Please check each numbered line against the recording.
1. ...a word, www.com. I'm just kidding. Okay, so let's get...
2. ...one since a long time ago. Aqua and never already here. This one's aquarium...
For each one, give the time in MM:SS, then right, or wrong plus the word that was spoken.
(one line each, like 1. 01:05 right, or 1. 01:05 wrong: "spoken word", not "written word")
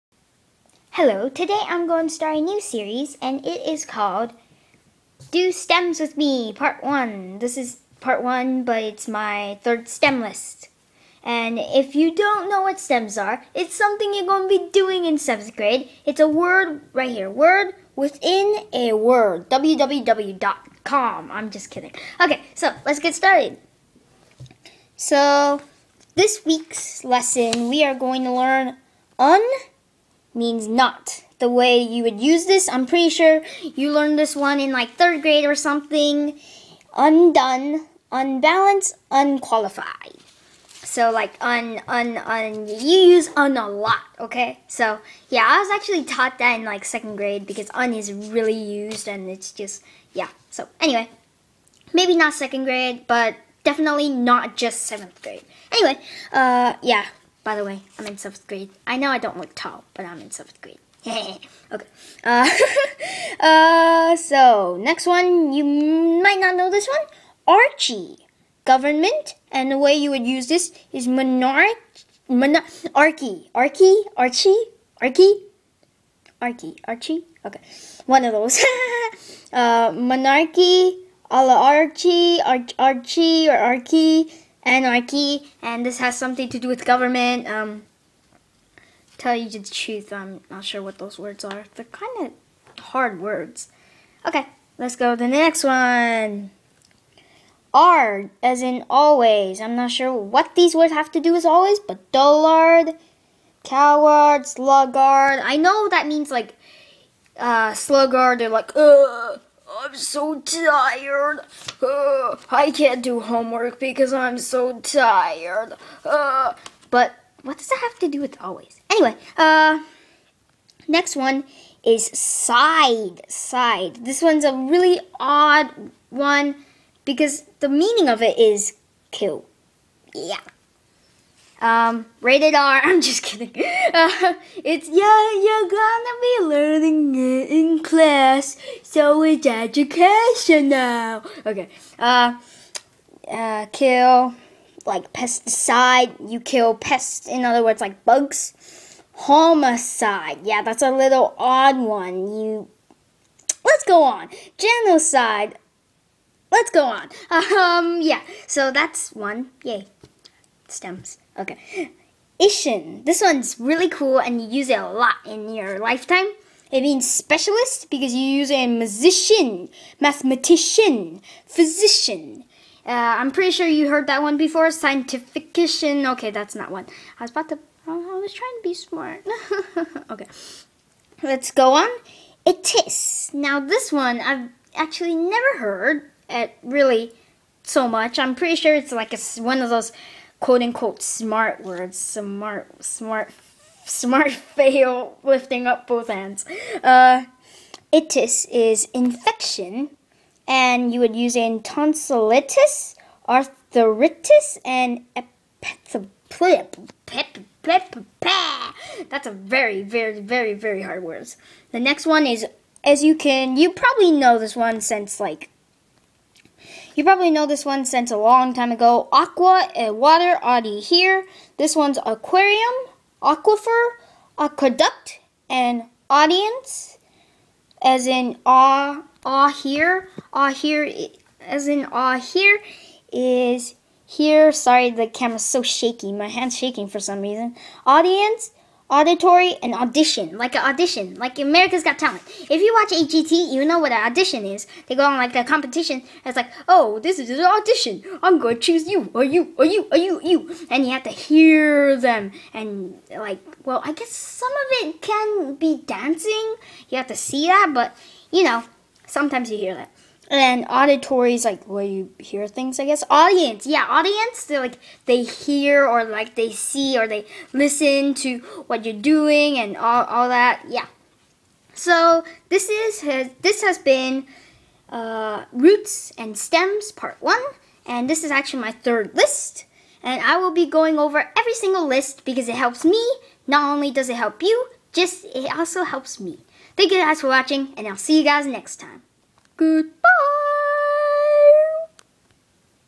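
1. 00:18 right
2. 03:37 wrong: "water", not "never".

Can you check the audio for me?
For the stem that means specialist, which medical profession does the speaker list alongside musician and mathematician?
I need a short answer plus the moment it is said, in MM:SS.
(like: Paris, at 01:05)
physician, at 02:51.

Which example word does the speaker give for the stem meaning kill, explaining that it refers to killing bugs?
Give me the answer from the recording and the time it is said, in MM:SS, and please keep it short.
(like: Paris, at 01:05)
pesticide, at 02:25.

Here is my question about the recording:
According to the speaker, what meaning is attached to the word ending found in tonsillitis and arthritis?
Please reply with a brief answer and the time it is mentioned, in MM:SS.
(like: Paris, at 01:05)
infection, at 03:18.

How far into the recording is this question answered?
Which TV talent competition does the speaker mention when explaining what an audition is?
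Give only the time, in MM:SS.
04:01.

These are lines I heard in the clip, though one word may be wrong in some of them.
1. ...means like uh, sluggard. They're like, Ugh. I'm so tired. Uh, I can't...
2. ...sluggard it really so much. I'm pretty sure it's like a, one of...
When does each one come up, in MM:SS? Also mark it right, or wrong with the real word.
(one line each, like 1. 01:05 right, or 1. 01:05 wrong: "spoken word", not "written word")
1. 01:46 right
2. 03:05 wrong: "heard", not "sluggard".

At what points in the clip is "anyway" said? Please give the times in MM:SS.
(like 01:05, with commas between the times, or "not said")
00:50, 00:55, 01:58.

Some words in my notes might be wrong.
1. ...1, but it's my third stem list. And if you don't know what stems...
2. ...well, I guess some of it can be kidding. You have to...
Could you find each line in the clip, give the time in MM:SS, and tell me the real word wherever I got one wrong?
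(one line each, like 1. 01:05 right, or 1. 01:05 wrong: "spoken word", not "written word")
1. 00:08 right
2. 04:13 wrong: "dancing", not "kidding".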